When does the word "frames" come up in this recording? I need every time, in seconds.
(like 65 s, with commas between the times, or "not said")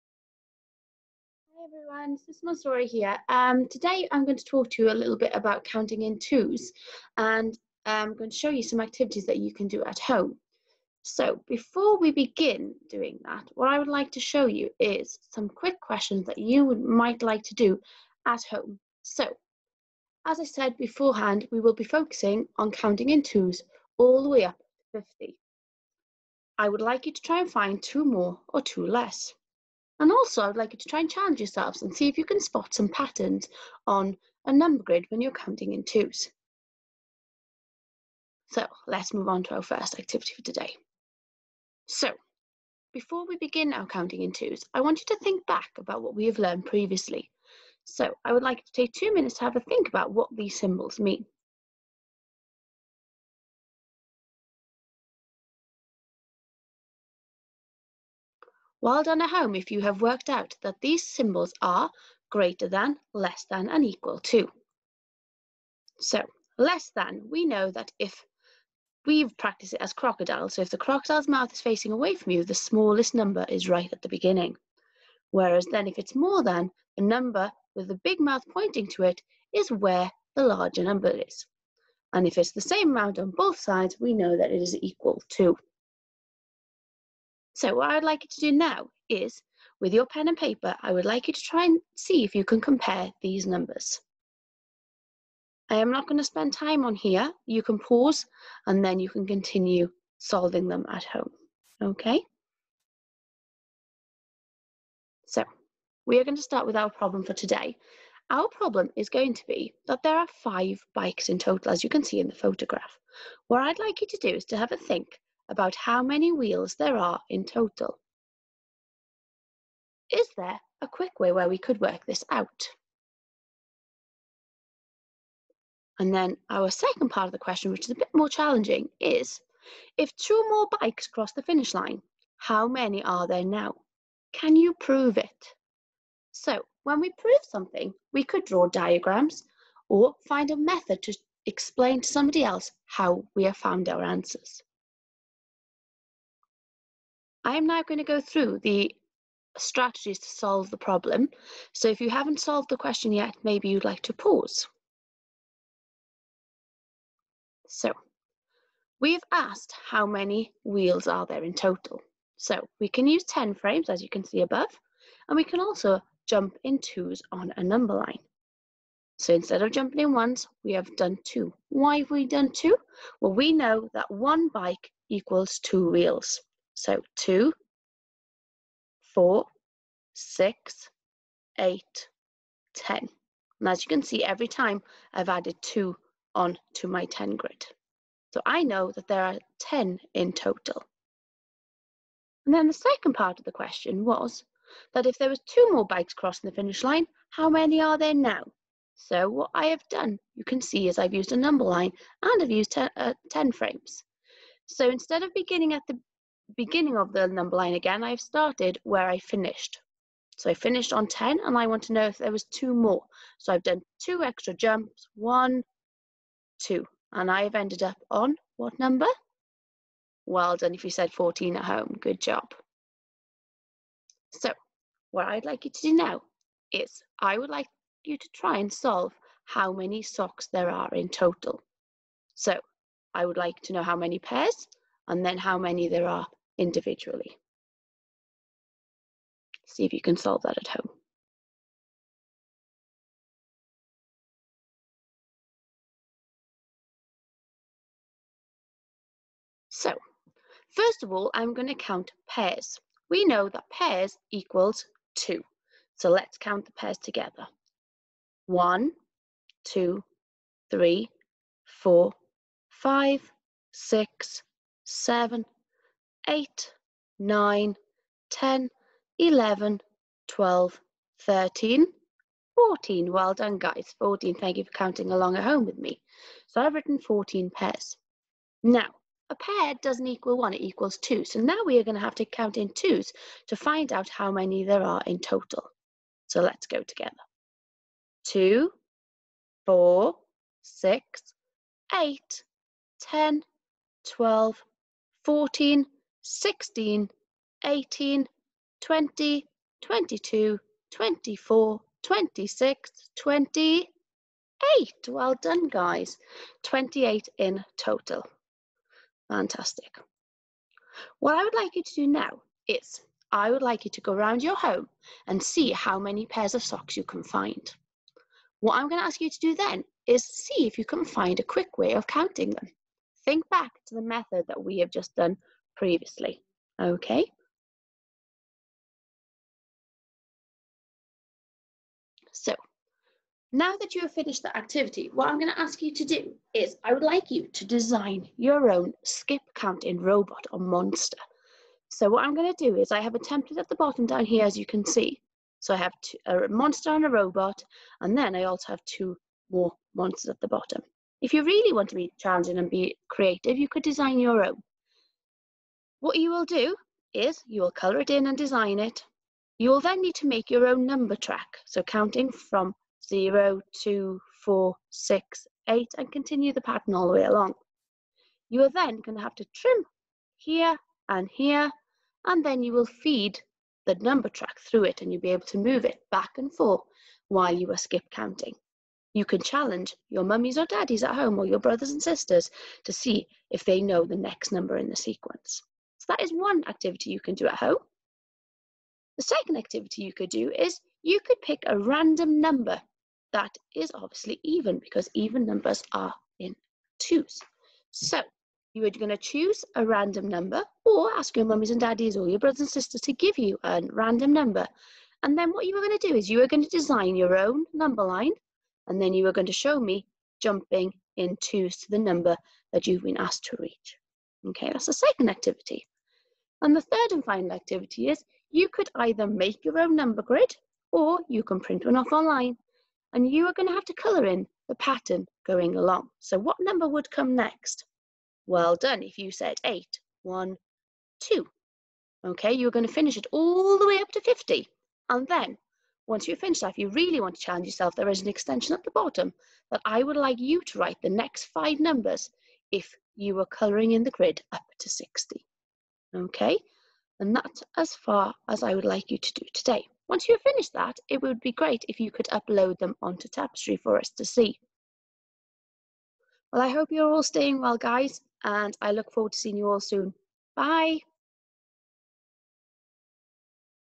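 163 s, 203 s.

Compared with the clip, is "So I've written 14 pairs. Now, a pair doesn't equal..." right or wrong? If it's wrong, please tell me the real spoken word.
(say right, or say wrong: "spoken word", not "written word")
right.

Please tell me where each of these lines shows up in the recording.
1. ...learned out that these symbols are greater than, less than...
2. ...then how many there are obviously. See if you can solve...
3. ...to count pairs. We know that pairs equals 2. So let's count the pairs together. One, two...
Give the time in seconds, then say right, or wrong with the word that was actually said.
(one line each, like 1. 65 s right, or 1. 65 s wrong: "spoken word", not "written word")
1. 60 s wrong: "worked", not "learned"
2. 235 s wrong: "individually", not "obviously"
3. 251 s right.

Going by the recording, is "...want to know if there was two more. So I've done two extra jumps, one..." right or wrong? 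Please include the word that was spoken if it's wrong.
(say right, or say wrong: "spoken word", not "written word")
right.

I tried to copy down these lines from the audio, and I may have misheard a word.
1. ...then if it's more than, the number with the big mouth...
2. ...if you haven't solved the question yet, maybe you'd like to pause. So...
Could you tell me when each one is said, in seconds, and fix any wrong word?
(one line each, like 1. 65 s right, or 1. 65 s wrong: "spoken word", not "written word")
1. 75 s right
2. 151 s right.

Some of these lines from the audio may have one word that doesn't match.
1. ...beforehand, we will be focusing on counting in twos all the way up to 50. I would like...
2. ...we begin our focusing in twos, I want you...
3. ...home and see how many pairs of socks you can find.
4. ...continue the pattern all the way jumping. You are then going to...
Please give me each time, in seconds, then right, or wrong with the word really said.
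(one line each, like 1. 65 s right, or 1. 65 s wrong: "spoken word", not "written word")
1. 20 s right
2. 43 s wrong: "counting", not "focusing"
3. 314 s right
4. 366 s wrong: "along", not "jumping".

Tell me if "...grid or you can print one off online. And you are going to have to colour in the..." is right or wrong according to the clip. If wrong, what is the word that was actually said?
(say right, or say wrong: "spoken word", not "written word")
right.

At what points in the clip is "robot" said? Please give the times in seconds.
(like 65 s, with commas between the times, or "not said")
339 s, 347 s.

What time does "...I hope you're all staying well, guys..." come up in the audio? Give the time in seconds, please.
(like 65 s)
456 s.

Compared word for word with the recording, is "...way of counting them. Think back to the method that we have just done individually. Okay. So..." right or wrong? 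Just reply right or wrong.
wrong.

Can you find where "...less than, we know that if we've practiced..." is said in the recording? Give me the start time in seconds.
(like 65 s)
66 s.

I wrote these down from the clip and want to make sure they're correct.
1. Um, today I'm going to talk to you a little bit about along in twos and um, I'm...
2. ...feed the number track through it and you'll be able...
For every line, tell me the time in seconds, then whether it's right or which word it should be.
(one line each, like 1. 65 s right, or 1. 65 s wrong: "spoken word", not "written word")
1. 3 s wrong: "counting", not "along"
2. 372 s right.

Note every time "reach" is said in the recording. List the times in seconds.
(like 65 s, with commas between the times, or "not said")
413 s.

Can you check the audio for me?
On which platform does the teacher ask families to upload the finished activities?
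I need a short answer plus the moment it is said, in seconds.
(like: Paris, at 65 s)
Tapestry, at 453 s.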